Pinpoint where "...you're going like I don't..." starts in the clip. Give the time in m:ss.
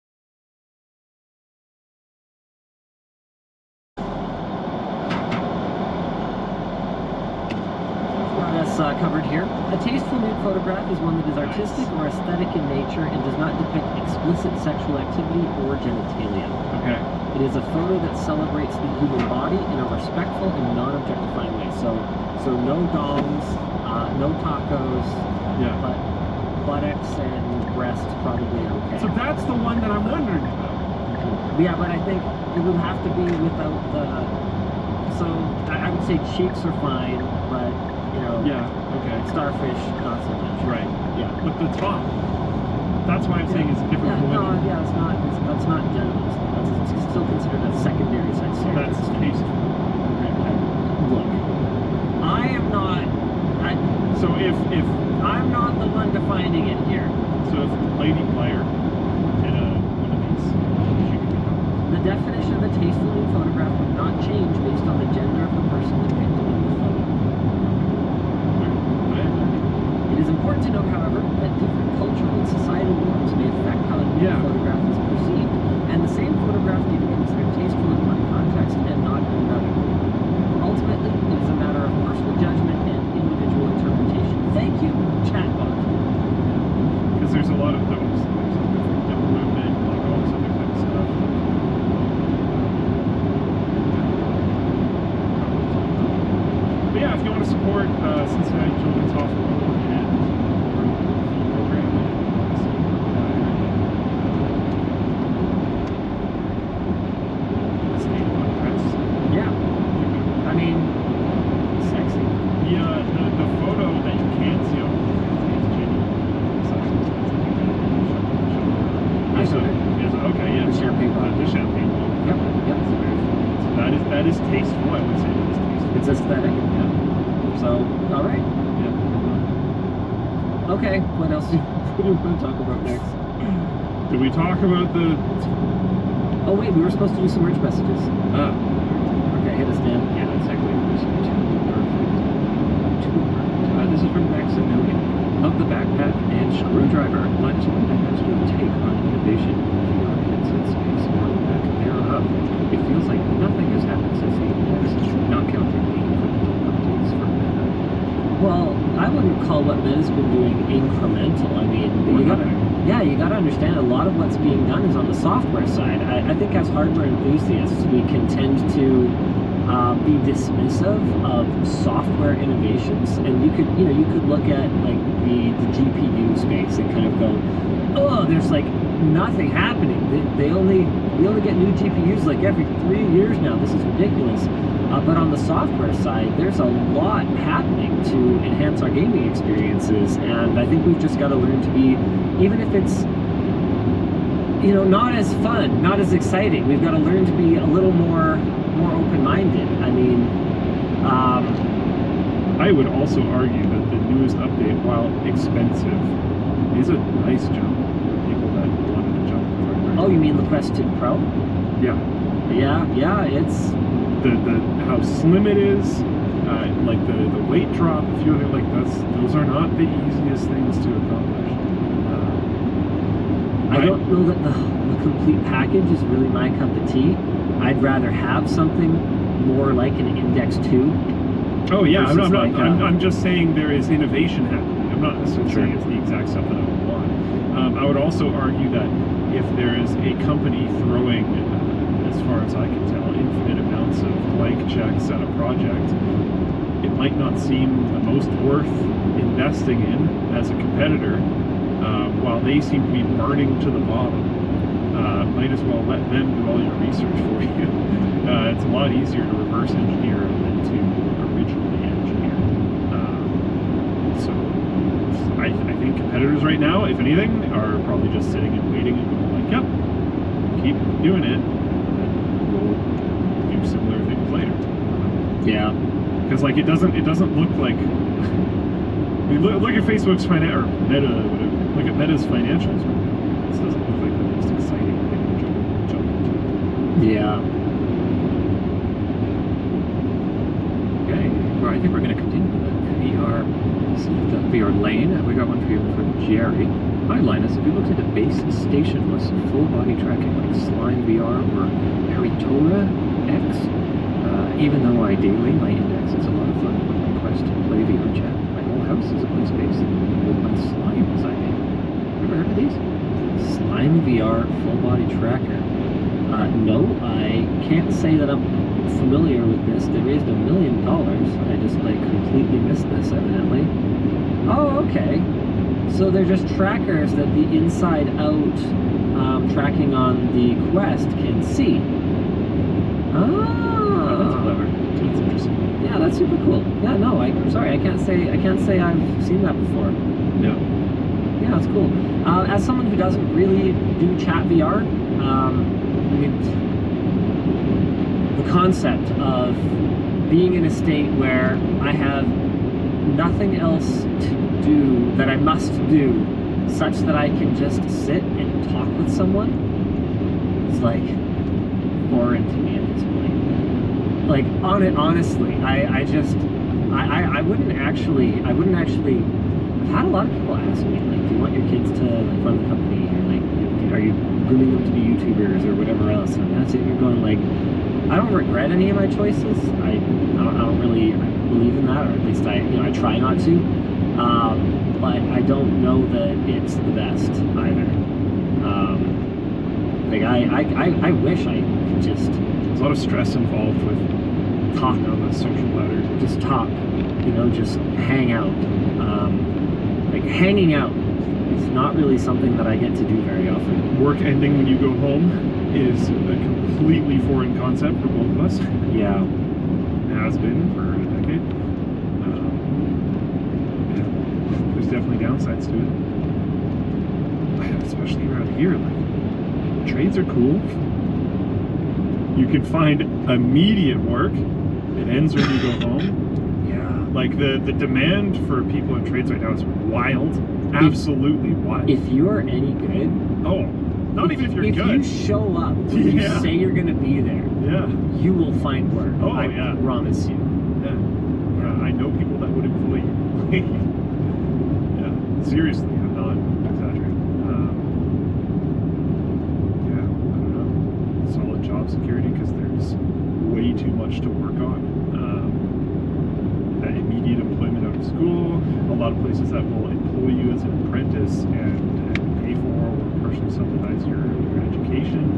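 6:16.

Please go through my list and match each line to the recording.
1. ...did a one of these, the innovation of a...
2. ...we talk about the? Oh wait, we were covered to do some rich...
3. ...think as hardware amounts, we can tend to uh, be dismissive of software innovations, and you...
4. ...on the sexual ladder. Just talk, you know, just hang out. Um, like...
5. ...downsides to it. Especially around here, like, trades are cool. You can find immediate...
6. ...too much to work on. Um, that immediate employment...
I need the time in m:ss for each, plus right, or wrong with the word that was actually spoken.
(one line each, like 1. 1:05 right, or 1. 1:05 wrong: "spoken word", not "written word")
1. 0:59 wrong: "definition", not "innovation"
2. 2:14 wrong: "supposed", not "covered"
3. 2:46 wrong: "enthusiasts", not "amounts"
4. 6:34 wrong: "social", not "sexual"
5. 6:55 right
6. 7:33 right.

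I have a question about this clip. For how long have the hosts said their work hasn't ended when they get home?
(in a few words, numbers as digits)
a decade.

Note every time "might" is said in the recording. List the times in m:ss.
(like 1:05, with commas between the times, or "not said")
4:06, 4:15.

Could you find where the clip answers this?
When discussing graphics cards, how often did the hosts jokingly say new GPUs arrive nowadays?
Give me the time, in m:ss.
3:02.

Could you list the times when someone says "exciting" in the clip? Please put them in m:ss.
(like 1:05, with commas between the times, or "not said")
3:16, 4:44.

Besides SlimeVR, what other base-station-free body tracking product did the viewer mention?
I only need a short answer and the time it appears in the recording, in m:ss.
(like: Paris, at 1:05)
Haritora X, at 5:02.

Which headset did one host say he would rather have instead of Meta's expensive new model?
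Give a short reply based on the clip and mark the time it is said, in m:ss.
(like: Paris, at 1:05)
Index 2, at 3:50.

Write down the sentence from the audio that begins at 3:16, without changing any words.
We've got to learn to be a little more more open-minded.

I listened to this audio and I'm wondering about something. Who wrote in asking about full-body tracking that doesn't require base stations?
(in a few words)
Jerry.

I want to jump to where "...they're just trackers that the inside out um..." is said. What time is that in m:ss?
5:26.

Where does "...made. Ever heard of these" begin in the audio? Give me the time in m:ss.
5:11.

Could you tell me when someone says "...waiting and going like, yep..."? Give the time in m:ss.
4:28.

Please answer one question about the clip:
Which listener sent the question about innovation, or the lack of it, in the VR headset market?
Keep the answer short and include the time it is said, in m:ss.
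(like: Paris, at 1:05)
Maximilian, at 2:24.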